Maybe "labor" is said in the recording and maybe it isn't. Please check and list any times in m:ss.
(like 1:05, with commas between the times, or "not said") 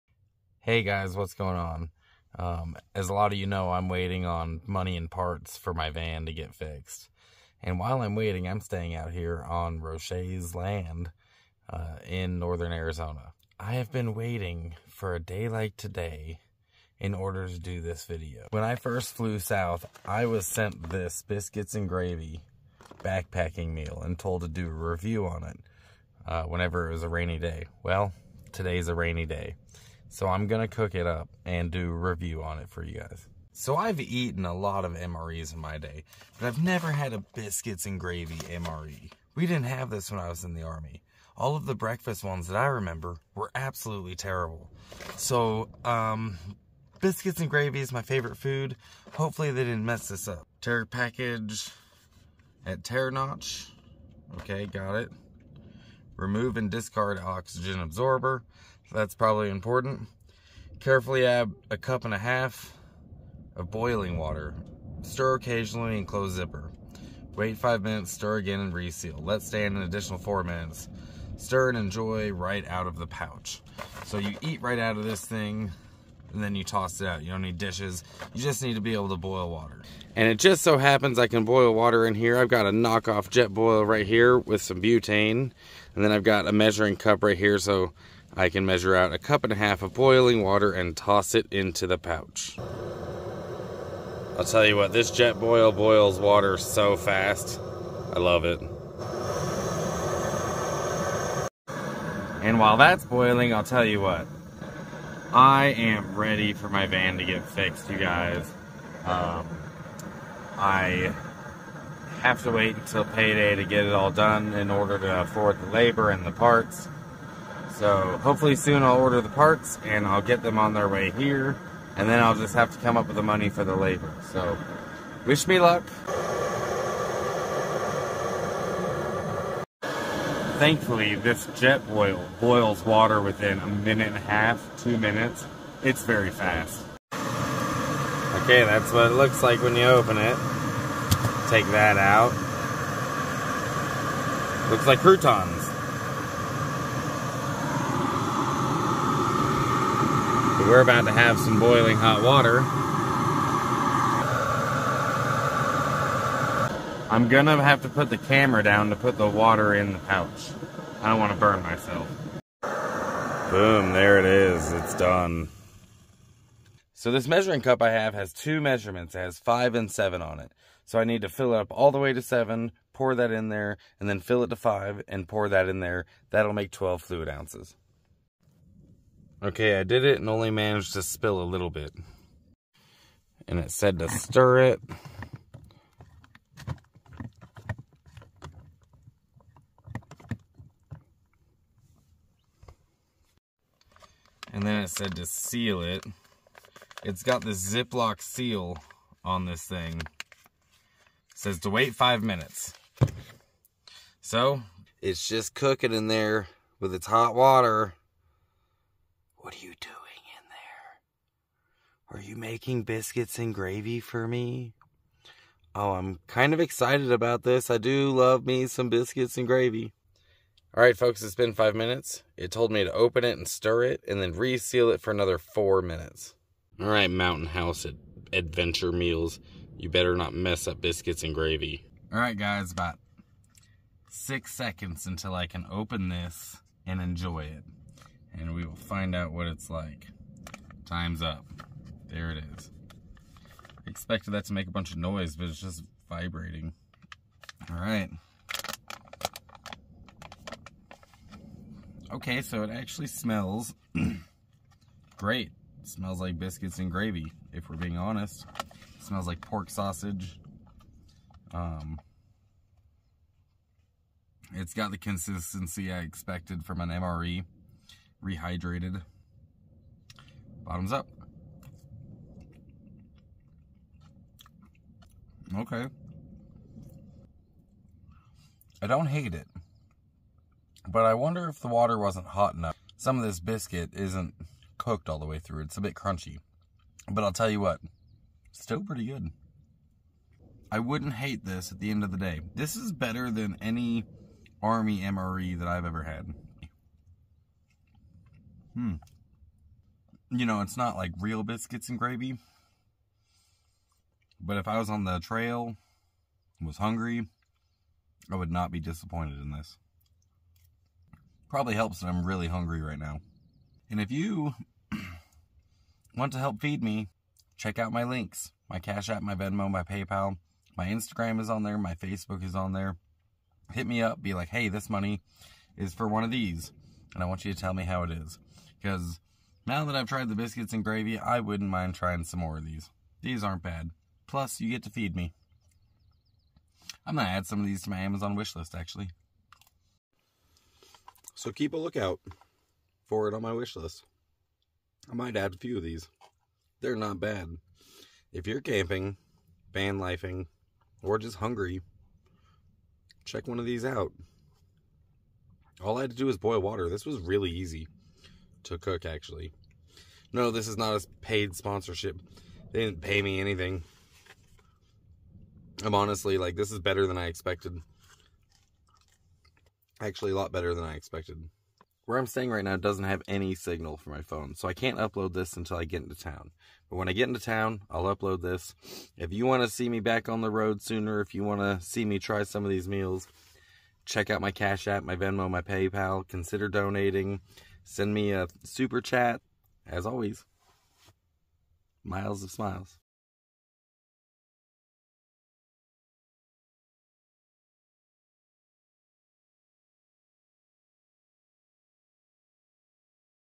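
1:55, 2:03.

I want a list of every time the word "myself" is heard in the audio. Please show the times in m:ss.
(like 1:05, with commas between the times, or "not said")
2:41.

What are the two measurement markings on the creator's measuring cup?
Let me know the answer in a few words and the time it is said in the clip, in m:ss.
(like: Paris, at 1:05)
5 and 7, at 2:49.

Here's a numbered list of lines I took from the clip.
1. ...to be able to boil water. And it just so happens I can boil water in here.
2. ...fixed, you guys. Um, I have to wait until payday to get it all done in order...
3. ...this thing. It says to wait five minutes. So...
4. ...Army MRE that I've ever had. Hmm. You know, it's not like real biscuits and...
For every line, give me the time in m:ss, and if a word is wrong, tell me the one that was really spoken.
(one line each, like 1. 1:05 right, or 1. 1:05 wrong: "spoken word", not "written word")
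1. 1:18 right
2. 1:47 right
3. 3:19 right
4. 4:54 right.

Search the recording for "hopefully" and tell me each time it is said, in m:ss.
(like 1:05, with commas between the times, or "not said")
0:49, 1:58.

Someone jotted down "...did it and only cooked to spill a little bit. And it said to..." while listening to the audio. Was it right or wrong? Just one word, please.
wrong.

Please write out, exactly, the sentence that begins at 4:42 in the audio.
Some of this biscuit isn't cooked all the way through.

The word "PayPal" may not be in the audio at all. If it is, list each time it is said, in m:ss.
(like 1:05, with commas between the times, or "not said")
5:19, 6:25.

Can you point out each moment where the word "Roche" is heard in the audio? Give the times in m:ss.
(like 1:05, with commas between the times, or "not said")
0:09.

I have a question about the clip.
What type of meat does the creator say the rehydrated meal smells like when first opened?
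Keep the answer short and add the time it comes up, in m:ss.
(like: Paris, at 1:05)
Pork sausage, at 4:19.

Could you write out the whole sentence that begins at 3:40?
All right, folks, it's been five minutes.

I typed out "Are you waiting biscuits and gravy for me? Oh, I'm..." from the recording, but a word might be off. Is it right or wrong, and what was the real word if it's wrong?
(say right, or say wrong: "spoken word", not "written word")
wrong: "making", not "waiting".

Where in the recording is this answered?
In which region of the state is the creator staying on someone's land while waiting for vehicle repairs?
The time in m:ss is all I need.
0:12.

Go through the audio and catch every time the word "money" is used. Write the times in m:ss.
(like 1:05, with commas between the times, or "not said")
0:04, 2:03, 5:24.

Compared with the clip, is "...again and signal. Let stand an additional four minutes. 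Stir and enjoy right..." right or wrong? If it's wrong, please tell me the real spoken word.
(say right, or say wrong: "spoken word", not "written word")
wrong: "reseal", not "signal".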